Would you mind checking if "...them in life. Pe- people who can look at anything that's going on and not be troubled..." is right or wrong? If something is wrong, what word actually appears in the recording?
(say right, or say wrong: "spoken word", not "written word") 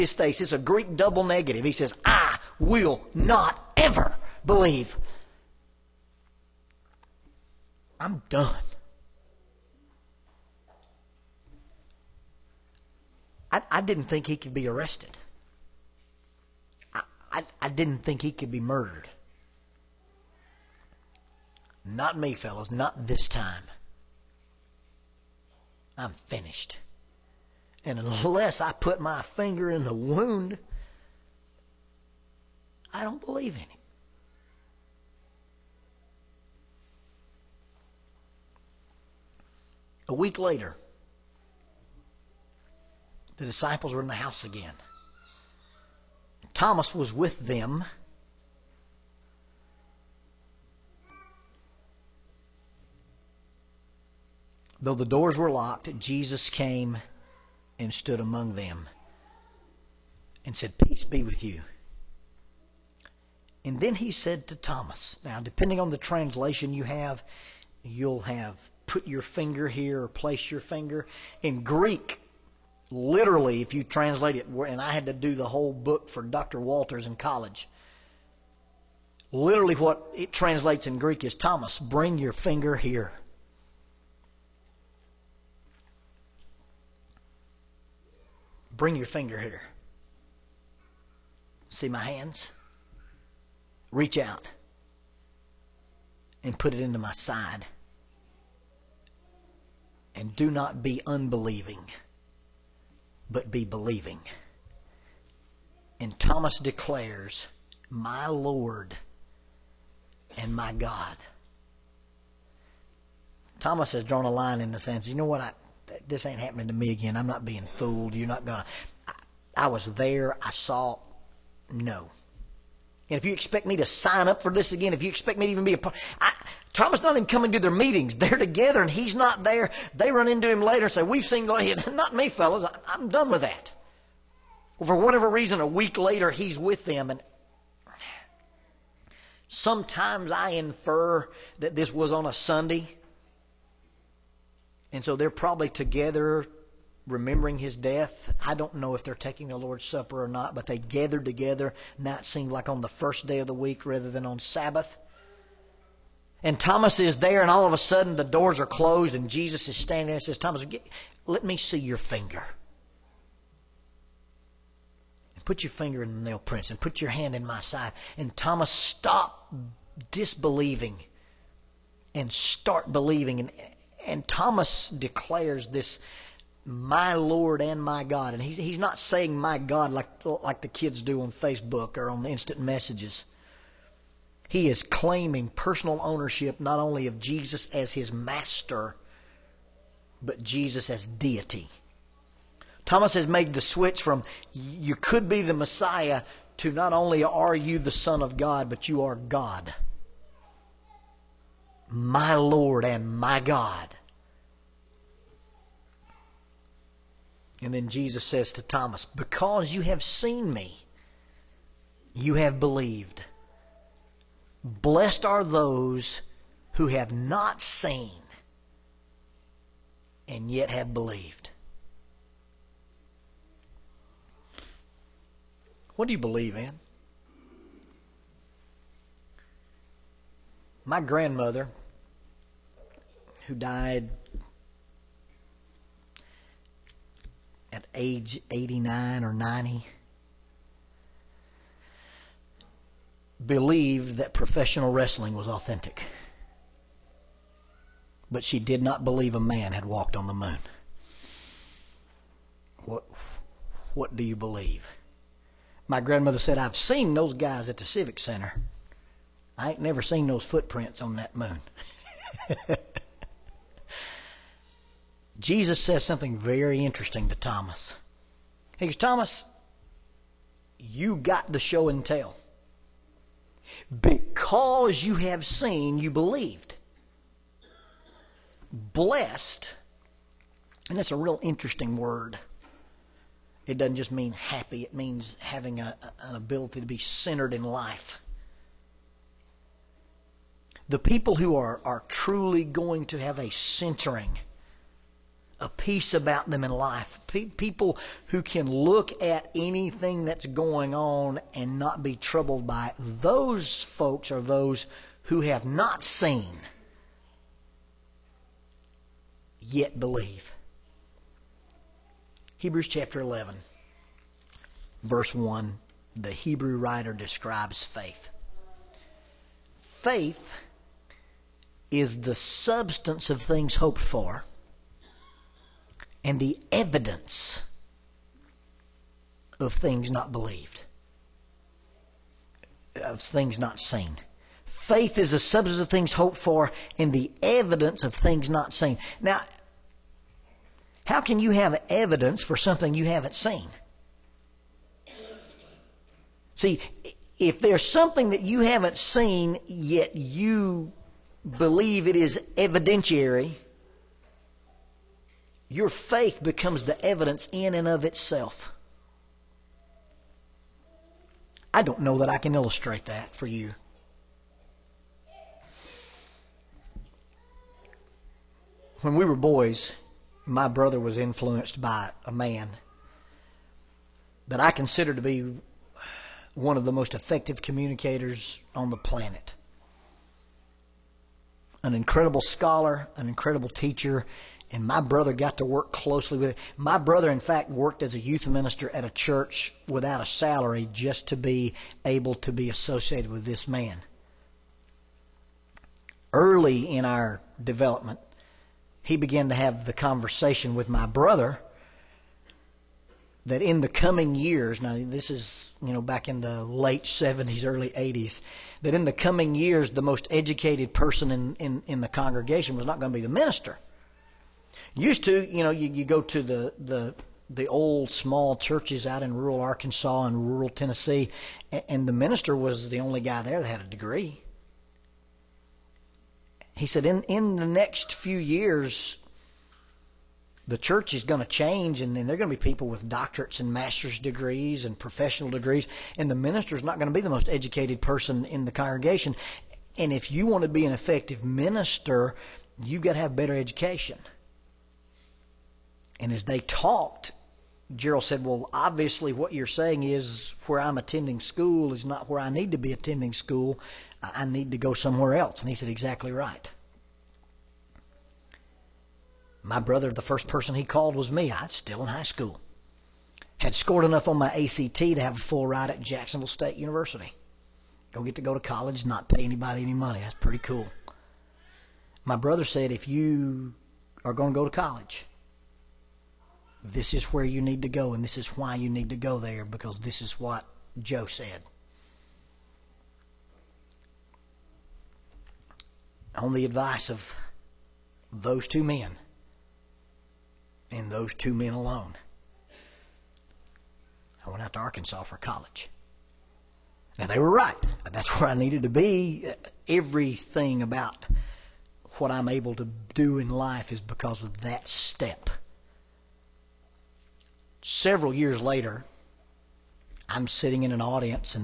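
right.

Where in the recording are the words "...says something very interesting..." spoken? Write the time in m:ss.
4:25.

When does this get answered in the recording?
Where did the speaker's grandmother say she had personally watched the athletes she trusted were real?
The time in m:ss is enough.
4:17.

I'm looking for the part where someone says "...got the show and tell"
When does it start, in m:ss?
4:31.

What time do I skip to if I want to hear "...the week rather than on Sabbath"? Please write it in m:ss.
2:33.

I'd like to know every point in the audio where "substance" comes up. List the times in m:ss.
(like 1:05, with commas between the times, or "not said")
5:22, 5:35.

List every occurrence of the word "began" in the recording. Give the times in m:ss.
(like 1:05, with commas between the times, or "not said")
6:39.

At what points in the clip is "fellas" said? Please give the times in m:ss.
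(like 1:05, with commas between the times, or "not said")
0:22, 2:12.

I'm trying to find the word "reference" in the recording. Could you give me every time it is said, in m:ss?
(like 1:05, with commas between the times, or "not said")
not said.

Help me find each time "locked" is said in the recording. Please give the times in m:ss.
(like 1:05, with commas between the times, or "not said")
0:55.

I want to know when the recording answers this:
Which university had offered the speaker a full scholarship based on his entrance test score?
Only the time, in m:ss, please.
7:46.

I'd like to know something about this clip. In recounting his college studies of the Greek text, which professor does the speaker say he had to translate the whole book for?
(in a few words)
Dr. Walters.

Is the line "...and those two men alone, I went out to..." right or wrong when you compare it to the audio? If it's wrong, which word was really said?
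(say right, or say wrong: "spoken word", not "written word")
right.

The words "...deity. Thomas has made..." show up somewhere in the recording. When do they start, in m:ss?
3:11.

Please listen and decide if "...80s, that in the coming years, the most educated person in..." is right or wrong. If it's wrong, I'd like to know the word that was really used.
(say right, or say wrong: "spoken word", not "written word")
right.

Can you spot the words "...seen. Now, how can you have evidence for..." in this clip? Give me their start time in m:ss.
5:38.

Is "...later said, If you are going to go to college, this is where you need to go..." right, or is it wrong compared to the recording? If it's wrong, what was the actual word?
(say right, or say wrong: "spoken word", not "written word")
wrong: "brother", not "later".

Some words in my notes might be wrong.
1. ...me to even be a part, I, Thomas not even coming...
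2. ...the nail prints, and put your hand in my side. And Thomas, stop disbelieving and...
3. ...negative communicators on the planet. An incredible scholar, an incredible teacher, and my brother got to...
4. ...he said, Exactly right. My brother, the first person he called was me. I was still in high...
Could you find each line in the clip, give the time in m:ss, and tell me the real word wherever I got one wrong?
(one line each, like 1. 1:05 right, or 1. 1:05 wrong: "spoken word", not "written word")
1. 2:05 right
2. 2:46 right
3. 6:17 wrong: "effective", not "negative"
4. 7:35 right.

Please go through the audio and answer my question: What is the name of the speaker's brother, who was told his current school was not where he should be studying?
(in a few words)
Gerald.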